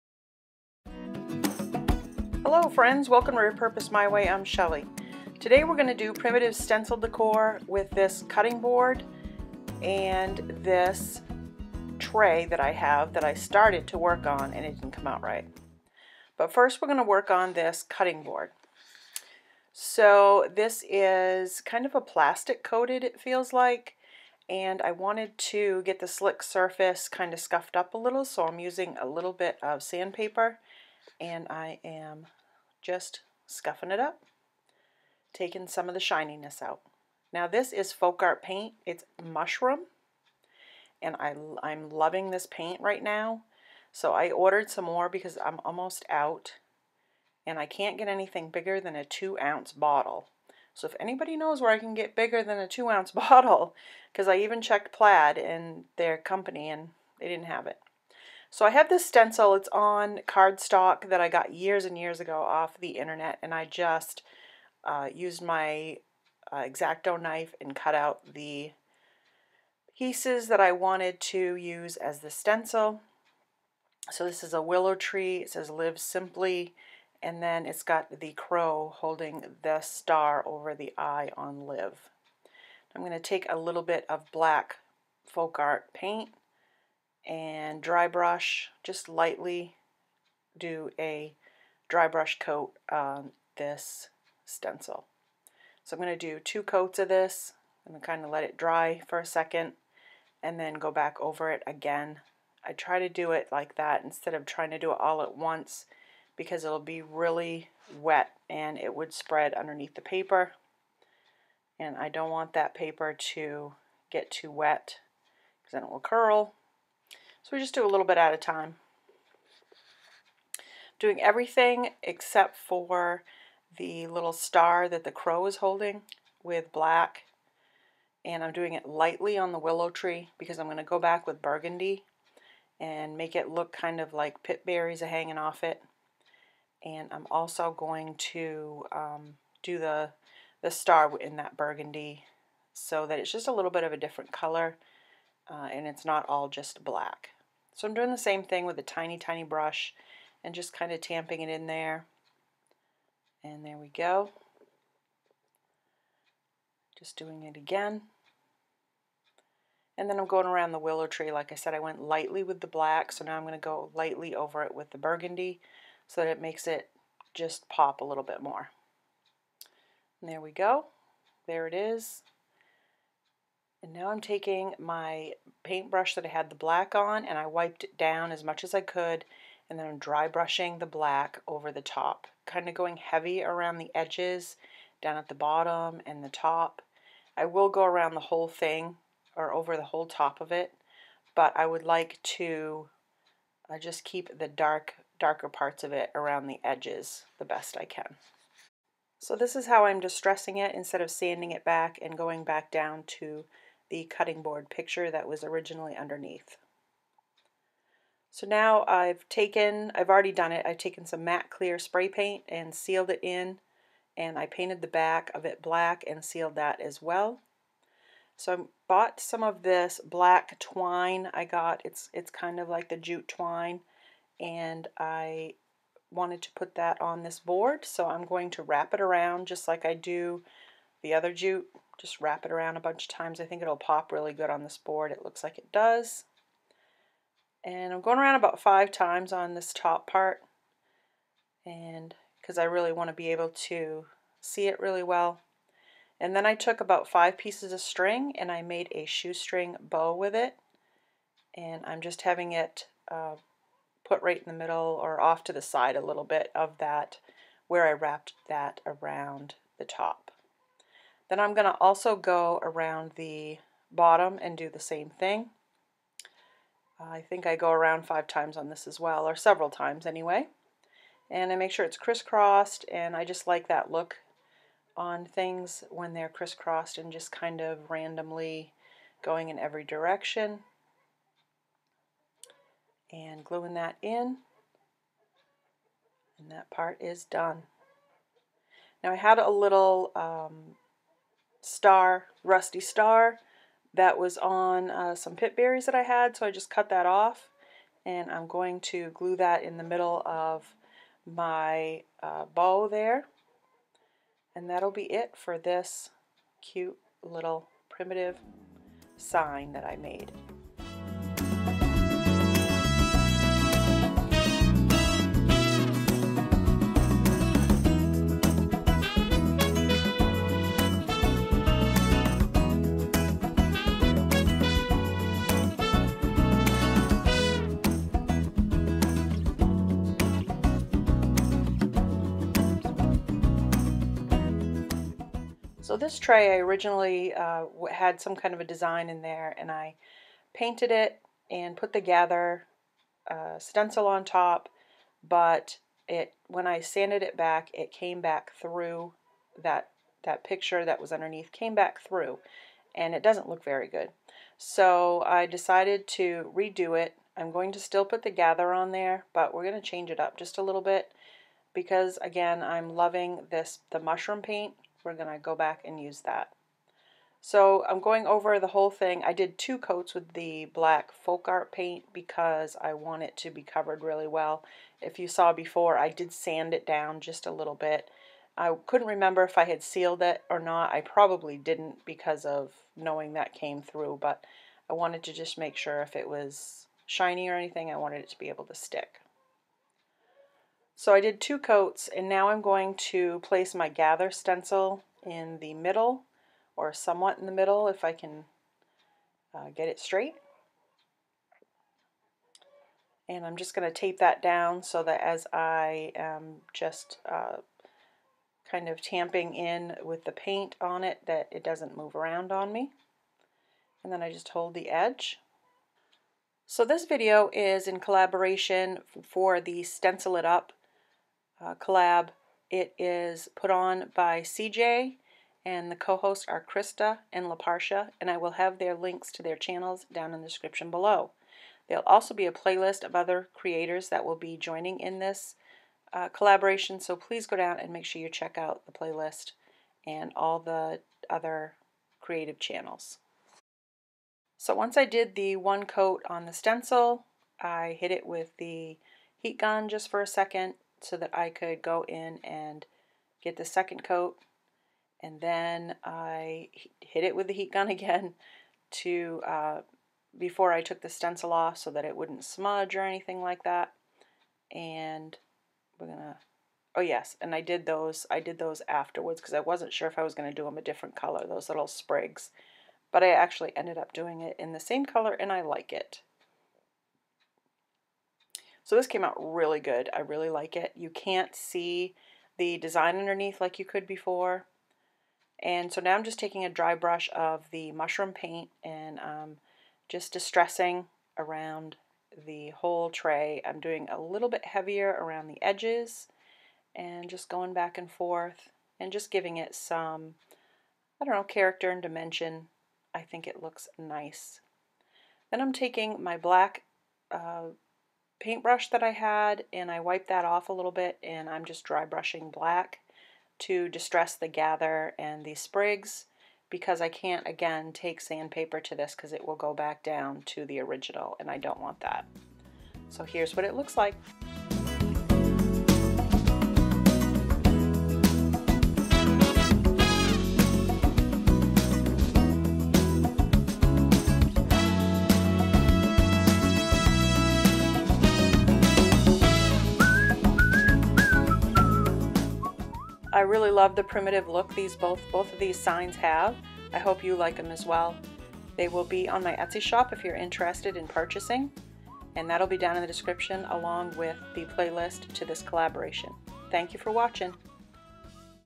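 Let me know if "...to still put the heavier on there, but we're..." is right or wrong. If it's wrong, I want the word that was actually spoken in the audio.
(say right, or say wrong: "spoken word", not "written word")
wrong: "gather", not "heavier".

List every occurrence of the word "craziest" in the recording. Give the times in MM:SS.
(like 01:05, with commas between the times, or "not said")
not said.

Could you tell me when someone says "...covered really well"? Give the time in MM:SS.
06:13.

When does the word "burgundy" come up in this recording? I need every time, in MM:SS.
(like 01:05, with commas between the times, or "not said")
02:11, 02:21, 02:44.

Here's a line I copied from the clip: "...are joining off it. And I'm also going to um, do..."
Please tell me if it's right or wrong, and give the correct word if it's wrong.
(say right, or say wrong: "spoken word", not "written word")
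wrong: "hanging", not "joining".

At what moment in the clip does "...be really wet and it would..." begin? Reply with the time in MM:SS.
01:46.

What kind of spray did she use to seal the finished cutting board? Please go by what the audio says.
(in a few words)
matte clear spray paint.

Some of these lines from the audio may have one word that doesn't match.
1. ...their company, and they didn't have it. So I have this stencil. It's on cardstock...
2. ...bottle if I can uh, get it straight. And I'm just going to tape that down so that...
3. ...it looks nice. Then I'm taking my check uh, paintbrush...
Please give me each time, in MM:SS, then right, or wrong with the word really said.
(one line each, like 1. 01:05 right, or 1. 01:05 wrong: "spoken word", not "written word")
1. 00:55 right
2. 06:37 wrong: "middle", not "bottle"
3. 08:23 wrong: "black", not "check".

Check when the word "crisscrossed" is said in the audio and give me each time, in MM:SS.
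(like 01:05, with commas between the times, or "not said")
04:31, 04:36.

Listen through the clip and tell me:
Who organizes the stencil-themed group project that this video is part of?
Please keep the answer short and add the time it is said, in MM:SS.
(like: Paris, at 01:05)
CeeJ, at 07:04.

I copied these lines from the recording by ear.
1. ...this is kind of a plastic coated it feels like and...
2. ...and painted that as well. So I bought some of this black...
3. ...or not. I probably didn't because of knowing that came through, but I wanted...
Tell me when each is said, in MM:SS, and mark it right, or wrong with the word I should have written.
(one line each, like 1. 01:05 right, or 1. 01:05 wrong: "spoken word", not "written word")
1. 00:20 right
2. 03:36 wrong: "sealed", not "painted"
3. 06:20 right.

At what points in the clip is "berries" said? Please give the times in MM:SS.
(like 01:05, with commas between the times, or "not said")
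02:14, 04:55.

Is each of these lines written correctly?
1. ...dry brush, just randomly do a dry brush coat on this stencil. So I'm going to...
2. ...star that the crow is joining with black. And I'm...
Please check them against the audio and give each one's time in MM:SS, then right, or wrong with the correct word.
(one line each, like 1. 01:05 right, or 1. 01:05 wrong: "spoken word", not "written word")
1. 01:27 wrong: "lightly", not "randomly"
2. 02:04 wrong: "holding", not "joining".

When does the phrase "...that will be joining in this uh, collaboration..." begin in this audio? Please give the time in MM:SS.
07:14.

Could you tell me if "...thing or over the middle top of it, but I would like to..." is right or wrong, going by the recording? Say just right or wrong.
wrong.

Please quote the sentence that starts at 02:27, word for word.
So I'm doing the same thing with a tiny, tiny brush and just kind of tamping it in there.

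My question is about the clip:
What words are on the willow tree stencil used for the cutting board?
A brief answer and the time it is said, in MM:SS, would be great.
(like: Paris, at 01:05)
live simply, at 01:15.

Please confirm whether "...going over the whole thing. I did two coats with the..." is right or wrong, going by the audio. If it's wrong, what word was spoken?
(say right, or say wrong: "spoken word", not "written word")
right.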